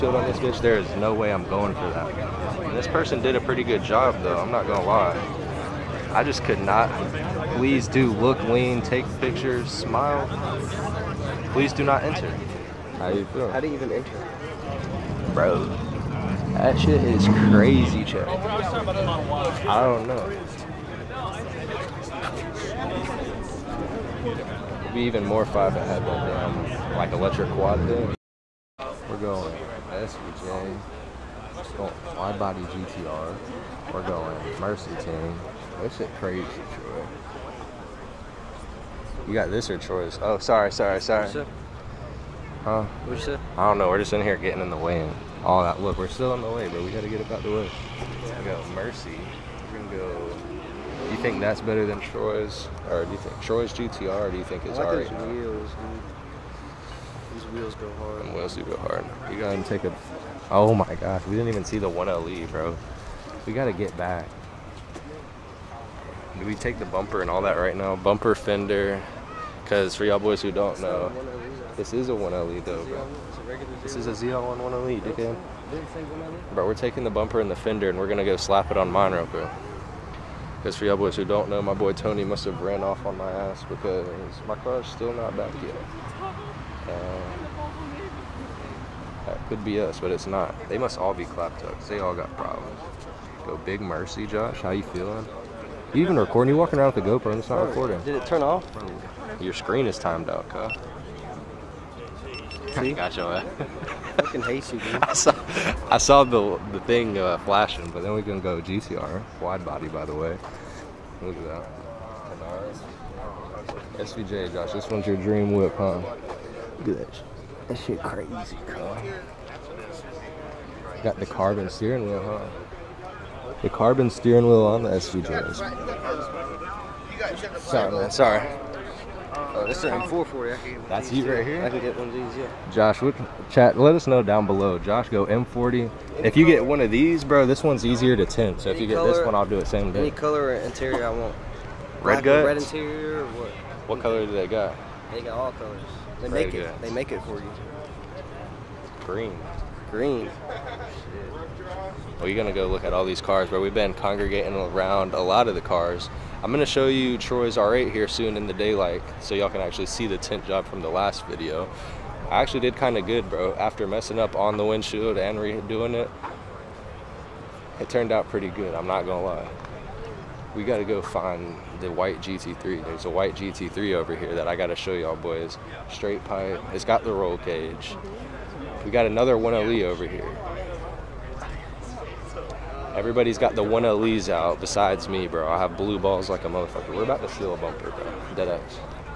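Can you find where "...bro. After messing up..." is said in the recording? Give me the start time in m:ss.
2:43.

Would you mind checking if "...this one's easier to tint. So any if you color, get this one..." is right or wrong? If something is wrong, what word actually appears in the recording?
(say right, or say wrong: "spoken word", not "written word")
right.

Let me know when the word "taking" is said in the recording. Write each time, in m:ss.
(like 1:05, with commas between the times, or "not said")
1:16.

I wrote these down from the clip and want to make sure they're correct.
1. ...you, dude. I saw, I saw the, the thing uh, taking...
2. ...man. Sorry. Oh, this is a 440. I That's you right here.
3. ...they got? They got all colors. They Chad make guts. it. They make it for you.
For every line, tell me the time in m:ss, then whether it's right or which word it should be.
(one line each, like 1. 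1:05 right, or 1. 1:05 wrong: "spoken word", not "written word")
1. 1:44 wrong: "flashing", not "taking"
2. 2:07 right
3. 2:24 wrong: "Red", not "Chad".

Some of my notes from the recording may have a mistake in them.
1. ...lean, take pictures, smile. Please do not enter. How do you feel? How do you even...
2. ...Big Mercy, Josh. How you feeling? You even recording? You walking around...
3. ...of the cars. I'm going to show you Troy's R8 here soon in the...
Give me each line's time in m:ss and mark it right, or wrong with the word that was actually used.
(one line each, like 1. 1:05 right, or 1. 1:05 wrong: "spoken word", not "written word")
1. 0:08 right
2. 1:33 right
3. 2:35 right.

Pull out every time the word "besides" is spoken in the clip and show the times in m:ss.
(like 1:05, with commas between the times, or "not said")
3:04.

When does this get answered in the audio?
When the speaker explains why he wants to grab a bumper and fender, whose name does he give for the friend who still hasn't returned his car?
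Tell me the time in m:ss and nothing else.
1:21.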